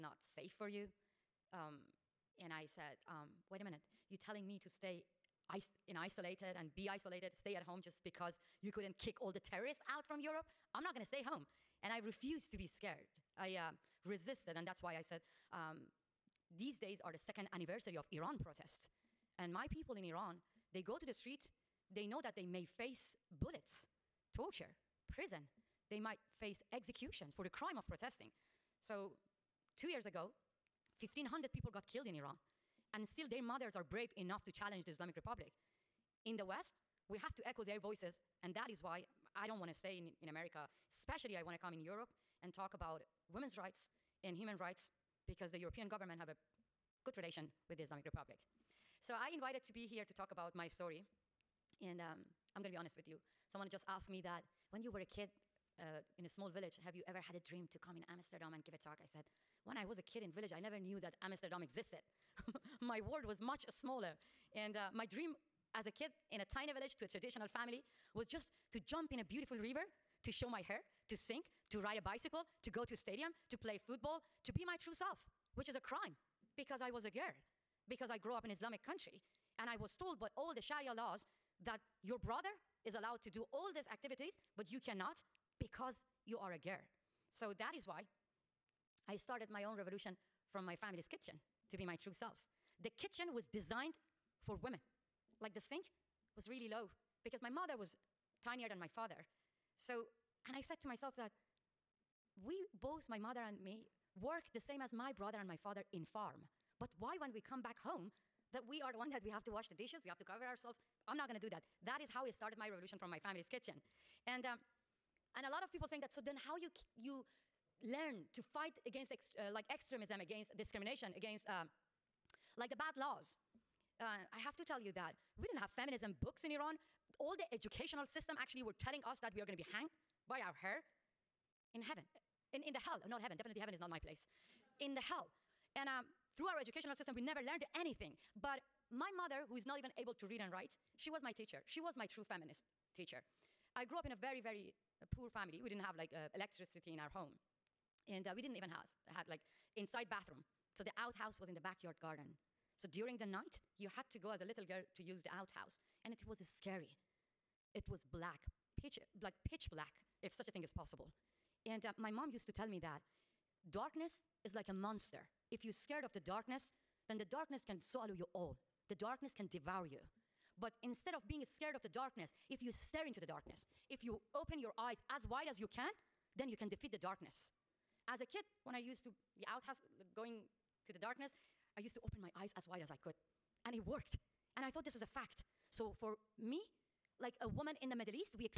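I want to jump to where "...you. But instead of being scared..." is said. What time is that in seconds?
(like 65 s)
169 s.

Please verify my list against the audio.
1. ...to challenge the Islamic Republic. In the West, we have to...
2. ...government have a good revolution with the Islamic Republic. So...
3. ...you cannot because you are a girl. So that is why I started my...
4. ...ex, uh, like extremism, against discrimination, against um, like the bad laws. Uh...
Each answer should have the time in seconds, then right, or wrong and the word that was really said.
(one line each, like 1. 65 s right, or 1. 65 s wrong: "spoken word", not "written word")
1. 34 s right
2. 45 s wrong: "relation", not "revolution"
3. 84 s right
4. 119 s right.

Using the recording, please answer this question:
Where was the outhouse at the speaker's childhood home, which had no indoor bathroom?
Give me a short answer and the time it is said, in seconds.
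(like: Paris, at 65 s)
Backyard garden, at 151 s.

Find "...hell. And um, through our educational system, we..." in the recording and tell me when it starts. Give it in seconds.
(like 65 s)
135 s.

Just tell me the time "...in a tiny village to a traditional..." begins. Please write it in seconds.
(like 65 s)
66 s.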